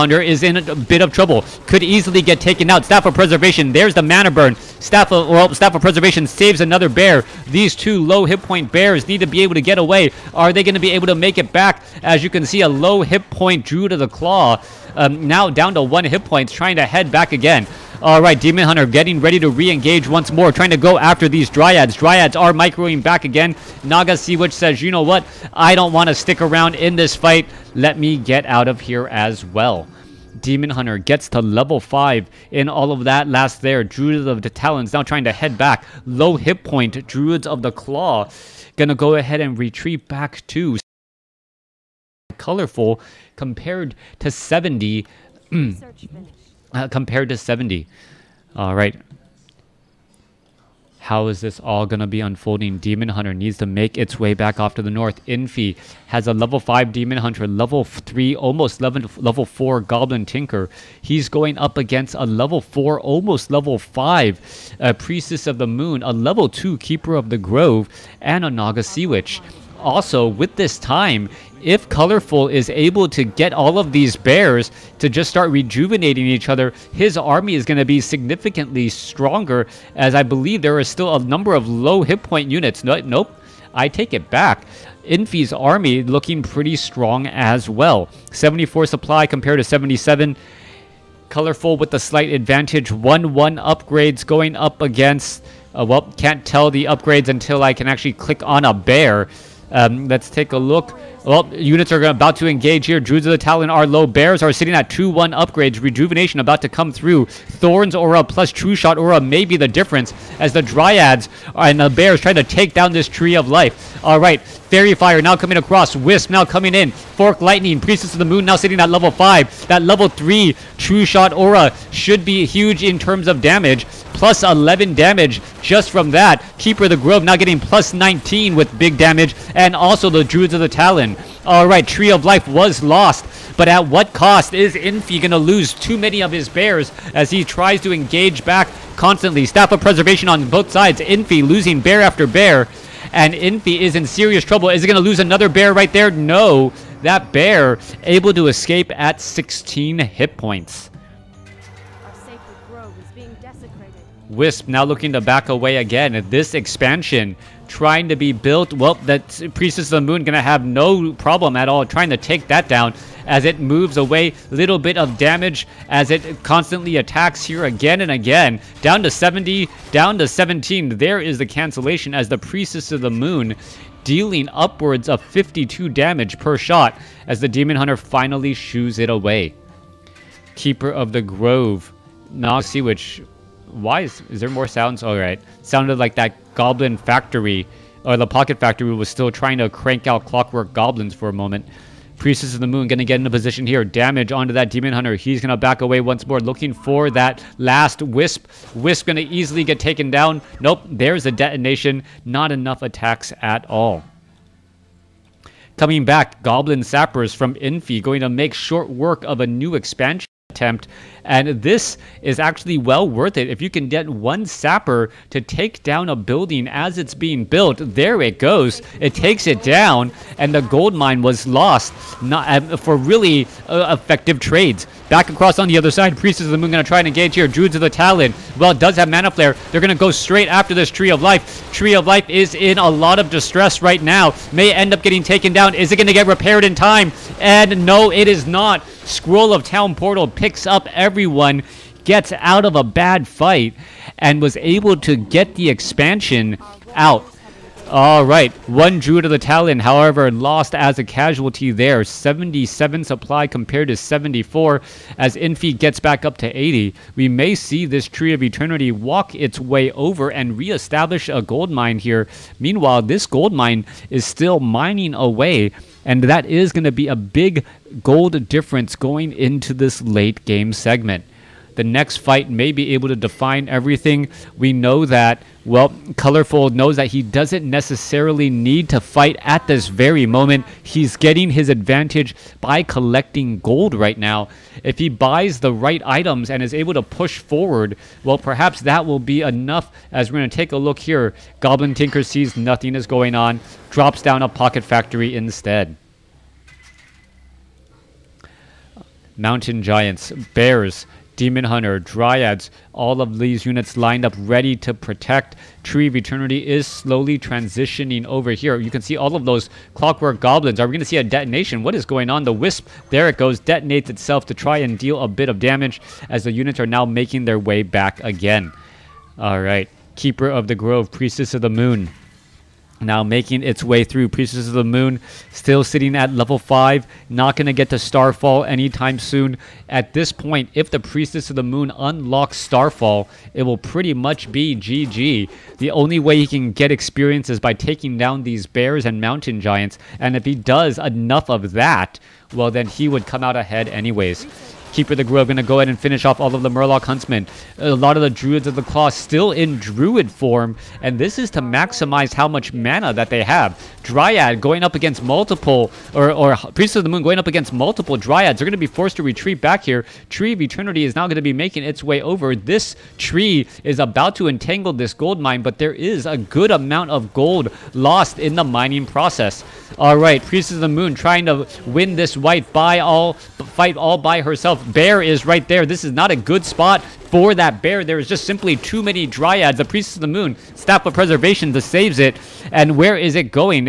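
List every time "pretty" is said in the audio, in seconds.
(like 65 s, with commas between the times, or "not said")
86 s, 333 s.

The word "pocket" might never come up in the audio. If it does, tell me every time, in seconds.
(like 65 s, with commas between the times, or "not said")
188 s, 294 s.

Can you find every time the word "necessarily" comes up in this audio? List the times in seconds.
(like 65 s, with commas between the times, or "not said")
277 s.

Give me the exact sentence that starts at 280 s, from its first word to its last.
He's getting his advantage by collecting gold right now.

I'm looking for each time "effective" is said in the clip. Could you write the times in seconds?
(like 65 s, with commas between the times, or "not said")
223 s.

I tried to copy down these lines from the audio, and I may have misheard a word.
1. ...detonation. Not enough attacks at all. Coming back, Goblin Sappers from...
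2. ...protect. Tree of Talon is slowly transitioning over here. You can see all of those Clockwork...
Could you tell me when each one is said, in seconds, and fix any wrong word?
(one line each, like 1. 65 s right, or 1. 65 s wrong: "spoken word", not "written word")
1. 201 s right
2. 304 s wrong: "Eternity", not "Talon".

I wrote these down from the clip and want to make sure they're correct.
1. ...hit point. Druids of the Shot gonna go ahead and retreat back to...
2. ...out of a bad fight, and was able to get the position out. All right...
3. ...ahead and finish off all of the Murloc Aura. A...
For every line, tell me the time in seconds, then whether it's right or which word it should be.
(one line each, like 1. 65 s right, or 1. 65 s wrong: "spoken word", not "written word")
1. 36 s wrong: "Claw", not "Shot"
2. 242 s wrong: "expansion", not "position"
3. 345 s wrong: "Huntsmen", not "Aura".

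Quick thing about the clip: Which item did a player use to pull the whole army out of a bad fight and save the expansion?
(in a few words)
Scroll of Town Portal.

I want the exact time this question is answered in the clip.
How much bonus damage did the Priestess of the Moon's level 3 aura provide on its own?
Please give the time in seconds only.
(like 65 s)
124 s.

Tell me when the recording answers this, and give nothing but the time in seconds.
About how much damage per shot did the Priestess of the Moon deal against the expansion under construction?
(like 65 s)
175 s.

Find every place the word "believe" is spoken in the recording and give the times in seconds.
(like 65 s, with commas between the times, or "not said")
80 s.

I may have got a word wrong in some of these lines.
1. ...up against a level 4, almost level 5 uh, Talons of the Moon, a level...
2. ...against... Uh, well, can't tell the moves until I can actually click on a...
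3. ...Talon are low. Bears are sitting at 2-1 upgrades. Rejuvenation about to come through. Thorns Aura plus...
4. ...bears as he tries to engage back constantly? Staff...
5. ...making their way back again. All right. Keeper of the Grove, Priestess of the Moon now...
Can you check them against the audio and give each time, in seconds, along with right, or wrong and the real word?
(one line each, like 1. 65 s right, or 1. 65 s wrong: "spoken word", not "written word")
1. 61 s wrong: "Priestess", not "Talons"
2. 94 s wrong: "upgrades", not "moves"
3. 103 s right
4. 136 s right
5. 317 s right.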